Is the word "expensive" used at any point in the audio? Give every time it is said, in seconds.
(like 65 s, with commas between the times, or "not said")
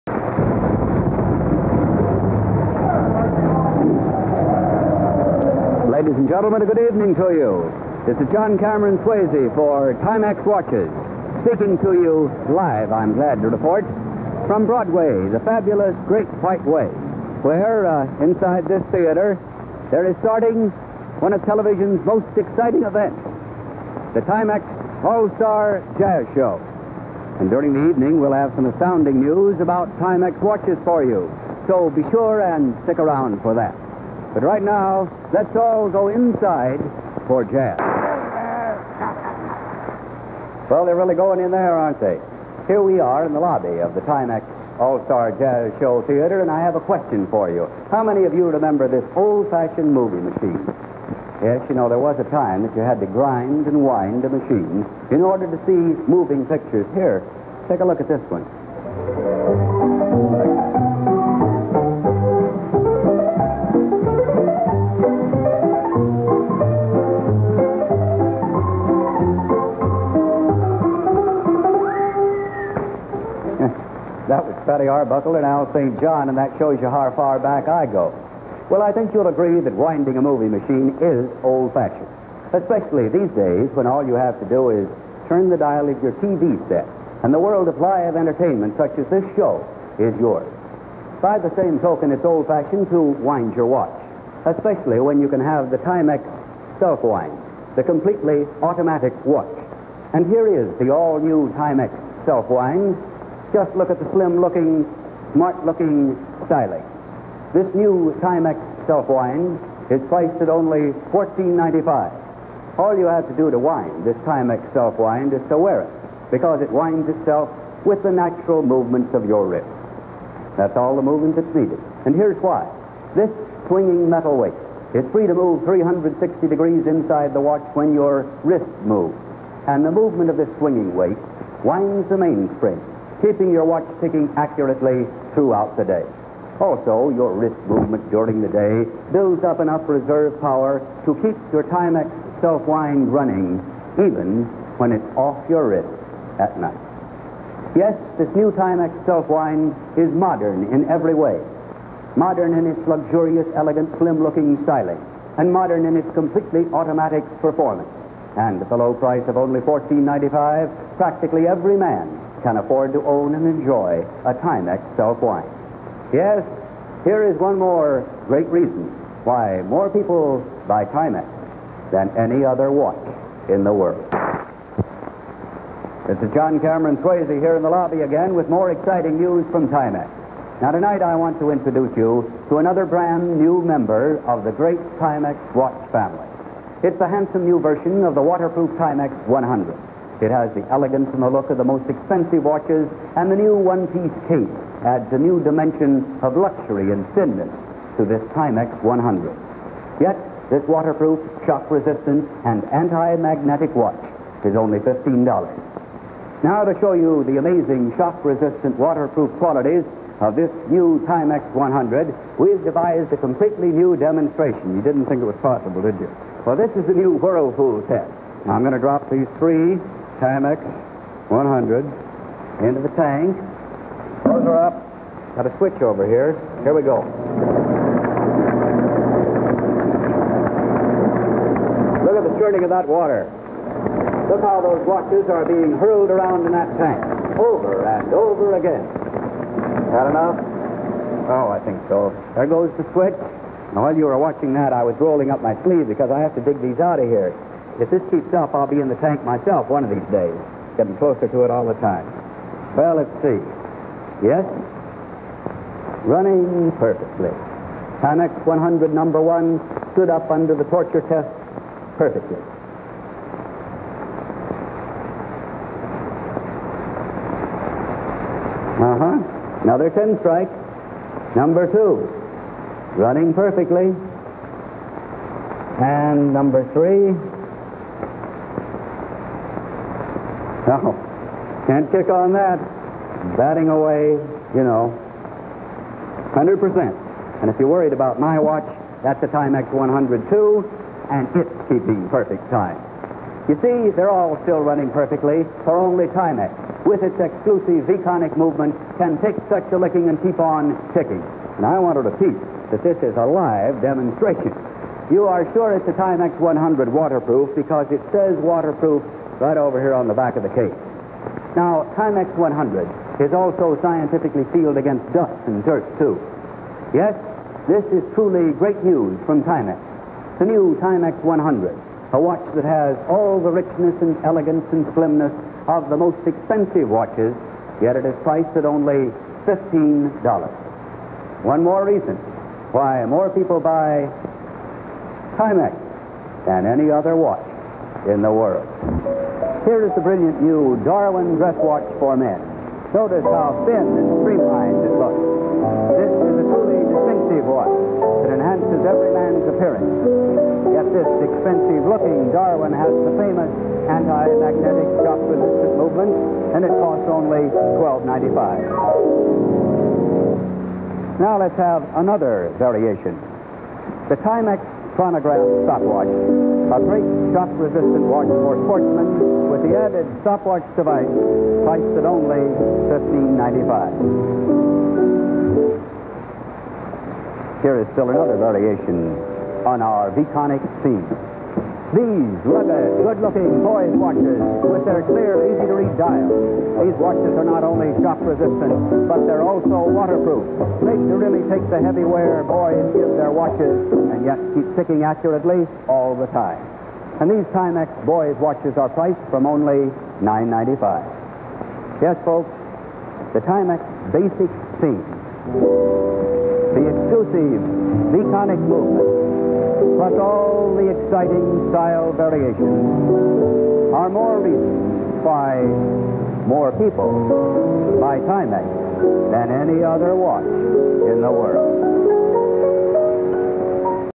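191 s, 326 s, 351 s.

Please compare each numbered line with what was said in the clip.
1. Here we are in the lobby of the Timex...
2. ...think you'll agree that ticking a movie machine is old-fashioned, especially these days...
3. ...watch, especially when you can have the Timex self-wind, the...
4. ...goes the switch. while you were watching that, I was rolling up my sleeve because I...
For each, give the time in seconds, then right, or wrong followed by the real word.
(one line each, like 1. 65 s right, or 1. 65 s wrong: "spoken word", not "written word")
1. 42 s right
2. 78 s wrong: "winding", not "ticking"
3. 93 s right
4. 242 s right.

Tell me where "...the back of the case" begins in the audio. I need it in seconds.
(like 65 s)
310 s.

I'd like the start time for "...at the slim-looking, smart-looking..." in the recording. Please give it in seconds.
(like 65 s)
103 s.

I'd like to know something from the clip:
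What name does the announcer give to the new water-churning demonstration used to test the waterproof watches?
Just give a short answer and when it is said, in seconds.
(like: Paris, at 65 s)
Whirlpool test, at 217 s.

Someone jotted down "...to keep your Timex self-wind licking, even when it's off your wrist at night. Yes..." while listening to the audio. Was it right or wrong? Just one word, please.
wrong.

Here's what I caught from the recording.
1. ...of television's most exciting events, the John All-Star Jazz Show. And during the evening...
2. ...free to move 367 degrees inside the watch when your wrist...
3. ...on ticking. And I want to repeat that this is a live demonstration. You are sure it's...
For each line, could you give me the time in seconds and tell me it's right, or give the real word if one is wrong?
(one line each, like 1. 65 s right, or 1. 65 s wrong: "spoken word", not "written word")
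1. 21 s wrong: "Timex", not "John"
2. 125 s wrong: "360", not "367"
3. 300 s right.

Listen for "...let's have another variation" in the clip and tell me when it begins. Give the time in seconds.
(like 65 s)
361 s.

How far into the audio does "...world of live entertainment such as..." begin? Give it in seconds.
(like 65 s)
87 s.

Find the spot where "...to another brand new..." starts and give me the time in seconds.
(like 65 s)
182 s.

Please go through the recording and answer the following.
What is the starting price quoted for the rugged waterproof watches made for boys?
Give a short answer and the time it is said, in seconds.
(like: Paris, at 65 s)
$9.95, at 400 s.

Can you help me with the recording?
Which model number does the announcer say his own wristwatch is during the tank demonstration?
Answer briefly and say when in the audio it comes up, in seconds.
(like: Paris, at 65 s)
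Timex 102, at 289 s.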